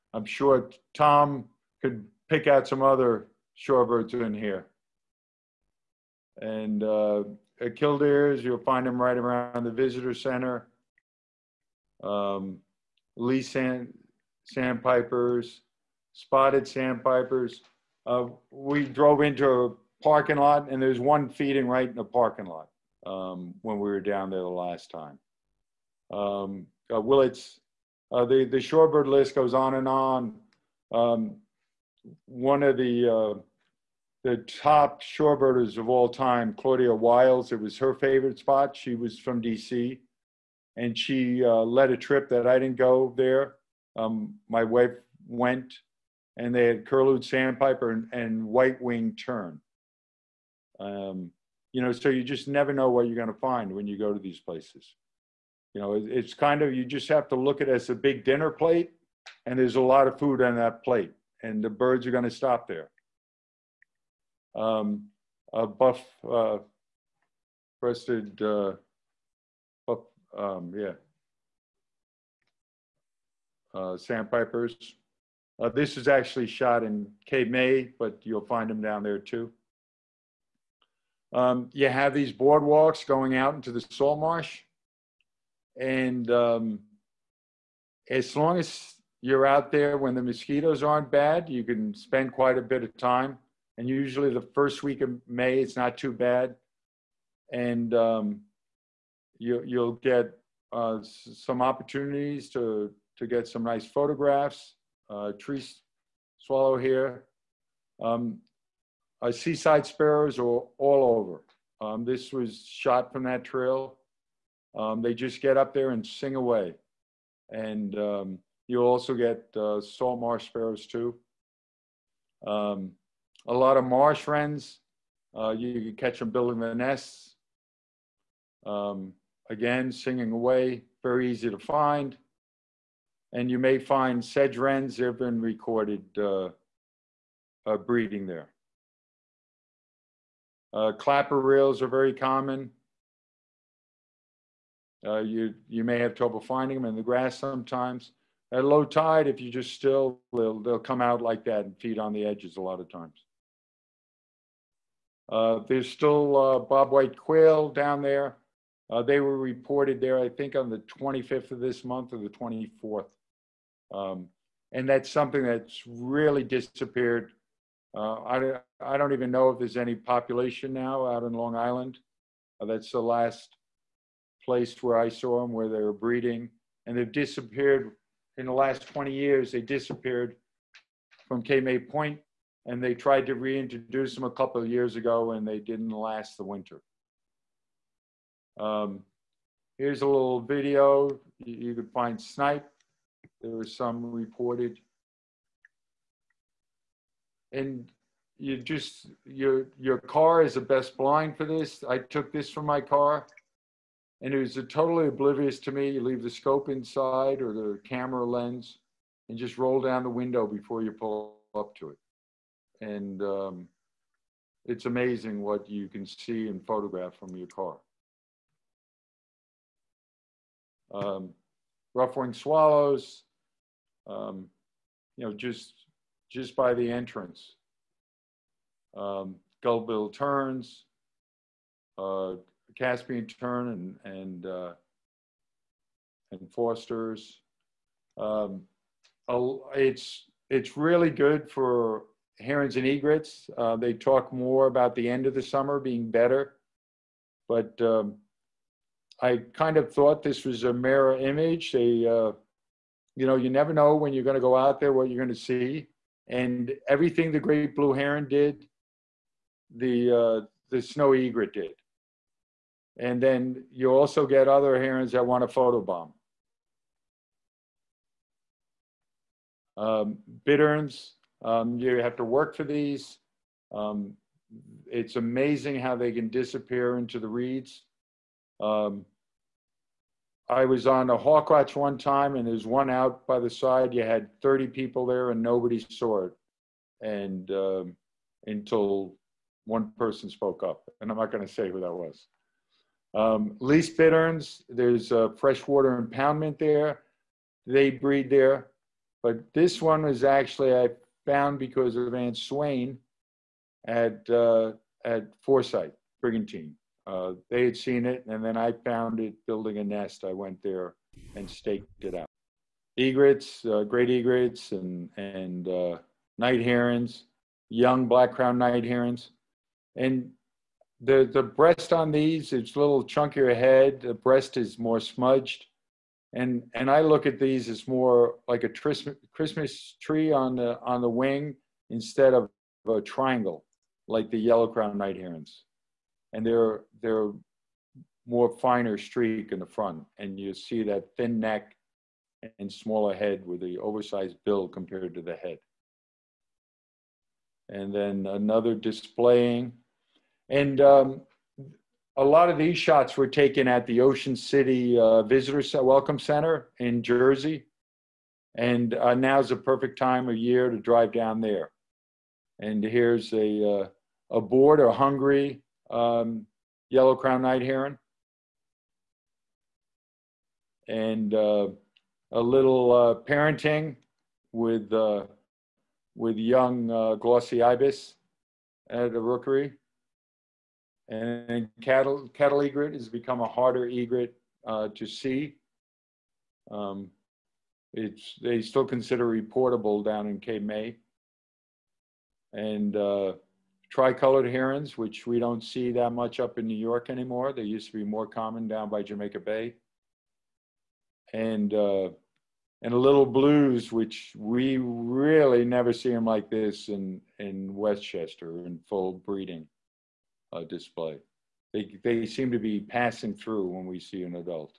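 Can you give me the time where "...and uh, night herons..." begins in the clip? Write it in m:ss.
5:15.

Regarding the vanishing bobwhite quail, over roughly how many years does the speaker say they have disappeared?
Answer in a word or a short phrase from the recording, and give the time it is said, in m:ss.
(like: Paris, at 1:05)
20, at 2:58.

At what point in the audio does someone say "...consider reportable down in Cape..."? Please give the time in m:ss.
6:28.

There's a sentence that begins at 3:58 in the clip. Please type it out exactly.
Um, it's it's really good for herons and egrets.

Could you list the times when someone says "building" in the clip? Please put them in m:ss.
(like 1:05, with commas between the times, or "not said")
2:06, 5:09.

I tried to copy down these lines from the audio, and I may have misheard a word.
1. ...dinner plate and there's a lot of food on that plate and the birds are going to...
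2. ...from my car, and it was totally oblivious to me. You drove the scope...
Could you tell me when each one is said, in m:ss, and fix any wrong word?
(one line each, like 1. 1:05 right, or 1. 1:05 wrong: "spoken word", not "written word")
1. 0:58 right
2. 3:22 wrong: "leave", not "drove".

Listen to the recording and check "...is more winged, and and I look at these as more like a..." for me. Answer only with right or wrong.
wrong.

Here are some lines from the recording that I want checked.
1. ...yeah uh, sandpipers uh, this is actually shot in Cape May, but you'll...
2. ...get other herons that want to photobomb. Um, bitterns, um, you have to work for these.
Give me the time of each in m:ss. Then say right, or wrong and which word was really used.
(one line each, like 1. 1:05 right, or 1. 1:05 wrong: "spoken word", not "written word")
1. 1:10 right
2. 4:24 right.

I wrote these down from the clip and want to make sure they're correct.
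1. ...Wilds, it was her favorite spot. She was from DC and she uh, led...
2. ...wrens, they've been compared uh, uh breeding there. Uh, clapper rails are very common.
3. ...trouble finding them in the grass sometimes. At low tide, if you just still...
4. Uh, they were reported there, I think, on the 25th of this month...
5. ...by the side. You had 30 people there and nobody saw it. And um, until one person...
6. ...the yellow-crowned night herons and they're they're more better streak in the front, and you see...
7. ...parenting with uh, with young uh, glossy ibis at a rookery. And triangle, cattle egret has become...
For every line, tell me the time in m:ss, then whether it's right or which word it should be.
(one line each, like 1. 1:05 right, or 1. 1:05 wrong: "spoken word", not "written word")
1. 0:36 right
2. 2:14 wrong: "recorded", not "compared"
3. 2:26 right
4. 2:38 right
5. 4:43 right
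6. 5:34 wrong: "finer", not "better"
7. 6:13 wrong: "cattle", not "triangle".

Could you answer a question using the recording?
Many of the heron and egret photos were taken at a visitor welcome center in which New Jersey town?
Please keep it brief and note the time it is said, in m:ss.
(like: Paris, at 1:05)
Ocean City, at 5:54.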